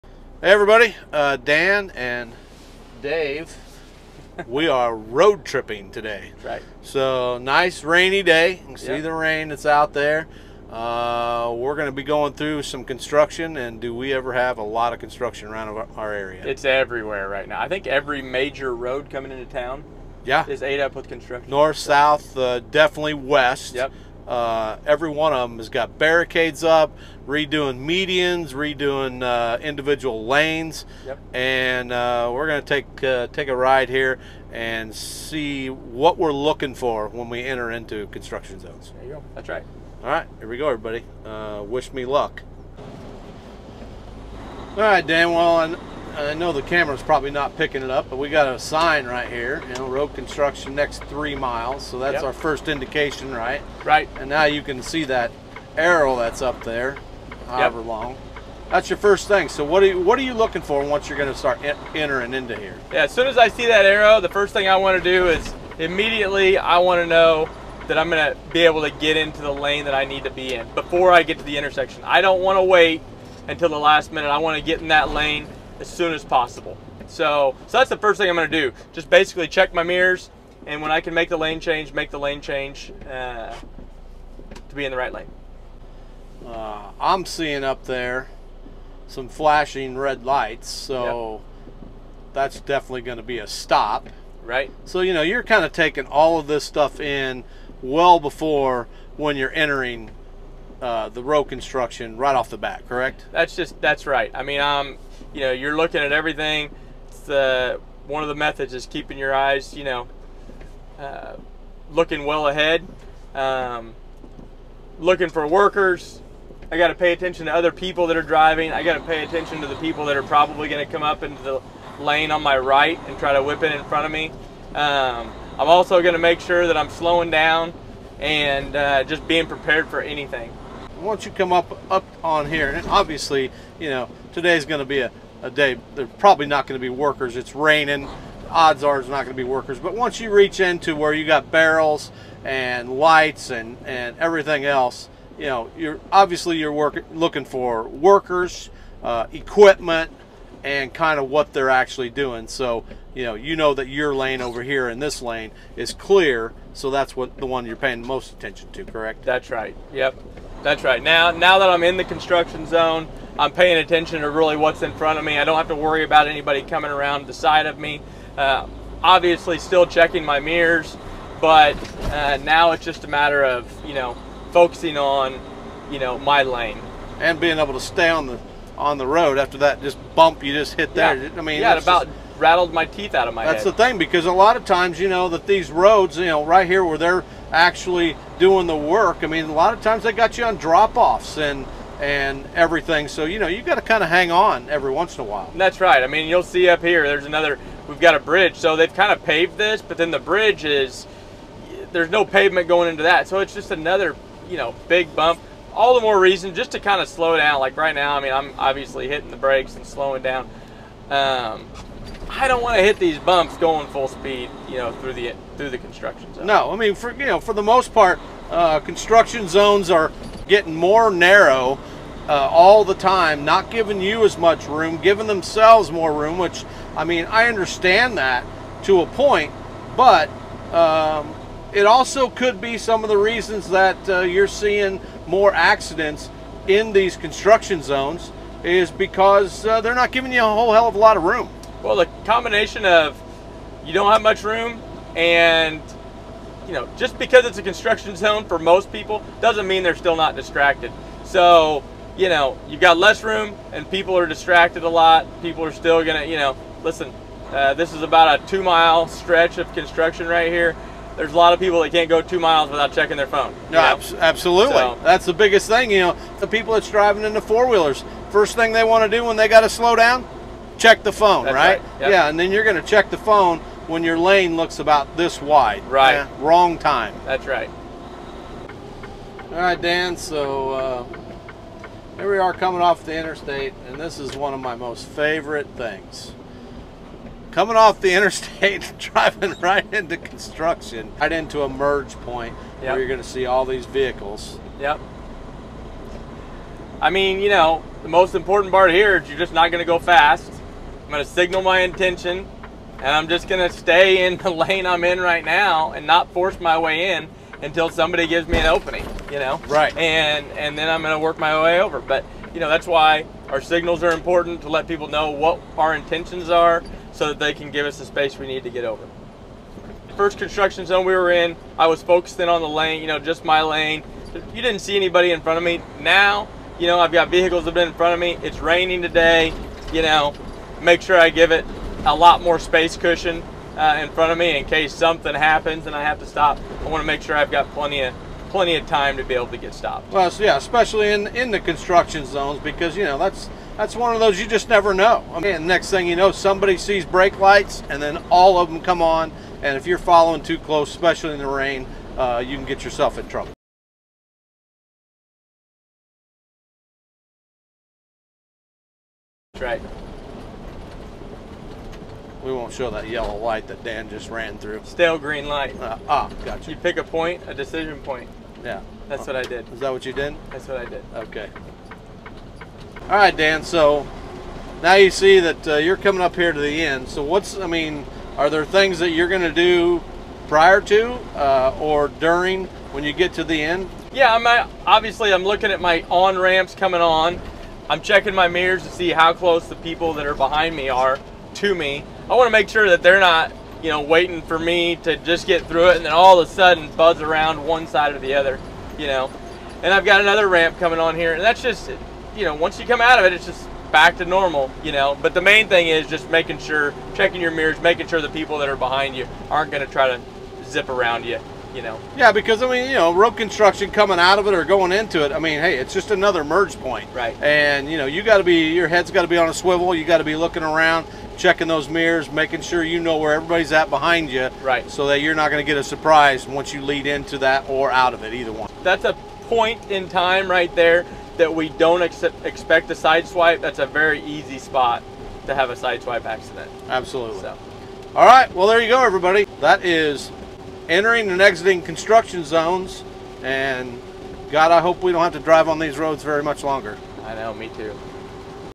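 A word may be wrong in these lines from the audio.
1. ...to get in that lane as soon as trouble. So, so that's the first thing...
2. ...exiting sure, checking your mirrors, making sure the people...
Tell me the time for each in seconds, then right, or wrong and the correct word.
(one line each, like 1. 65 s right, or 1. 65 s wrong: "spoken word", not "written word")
1. 74 s wrong: "possible", not "trouble"
2. 406 s wrong: "making", not "exiting".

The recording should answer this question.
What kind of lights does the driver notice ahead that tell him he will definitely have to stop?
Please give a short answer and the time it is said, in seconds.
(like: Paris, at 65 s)
flashing red lights, at 89 s.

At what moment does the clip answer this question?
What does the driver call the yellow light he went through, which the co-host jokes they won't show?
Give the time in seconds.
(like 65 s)
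364 s.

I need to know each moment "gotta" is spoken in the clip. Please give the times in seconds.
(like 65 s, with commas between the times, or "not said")
269 s.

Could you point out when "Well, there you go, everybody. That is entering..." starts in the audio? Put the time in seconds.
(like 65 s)
438 s.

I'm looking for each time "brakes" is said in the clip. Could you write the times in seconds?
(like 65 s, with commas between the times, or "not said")
209 s, 347 s.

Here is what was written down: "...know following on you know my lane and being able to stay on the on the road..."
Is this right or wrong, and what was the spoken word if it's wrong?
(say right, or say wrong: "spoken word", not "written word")
wrong: "focusing", not "following".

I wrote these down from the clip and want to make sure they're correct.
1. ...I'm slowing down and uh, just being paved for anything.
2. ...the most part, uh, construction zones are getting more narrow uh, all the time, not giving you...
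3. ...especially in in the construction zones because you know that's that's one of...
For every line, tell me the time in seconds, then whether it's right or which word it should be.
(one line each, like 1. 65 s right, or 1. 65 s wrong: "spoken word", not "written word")
1. 126 s wrong: "prepared", not "paved"
2. 217 s right
3. 340 s right.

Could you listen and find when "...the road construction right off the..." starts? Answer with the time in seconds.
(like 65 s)
101 s.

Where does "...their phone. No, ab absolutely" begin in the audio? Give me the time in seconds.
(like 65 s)
263 s.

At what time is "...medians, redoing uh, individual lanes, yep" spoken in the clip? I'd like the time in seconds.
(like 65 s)
27 s.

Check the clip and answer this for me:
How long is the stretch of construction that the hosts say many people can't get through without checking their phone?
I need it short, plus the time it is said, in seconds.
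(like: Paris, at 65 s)
2 miles, at 258 s.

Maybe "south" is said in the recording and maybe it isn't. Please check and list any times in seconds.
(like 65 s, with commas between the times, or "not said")
21 s.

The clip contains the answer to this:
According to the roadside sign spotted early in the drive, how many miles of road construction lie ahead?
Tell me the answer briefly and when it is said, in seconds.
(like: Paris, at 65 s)
3 miles, at 50 s.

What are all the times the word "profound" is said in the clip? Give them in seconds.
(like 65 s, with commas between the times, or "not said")
not said.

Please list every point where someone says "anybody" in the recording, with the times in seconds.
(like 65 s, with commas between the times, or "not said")
166 s, 324 s.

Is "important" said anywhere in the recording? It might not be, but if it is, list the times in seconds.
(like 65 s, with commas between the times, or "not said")
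298 s, 314 s.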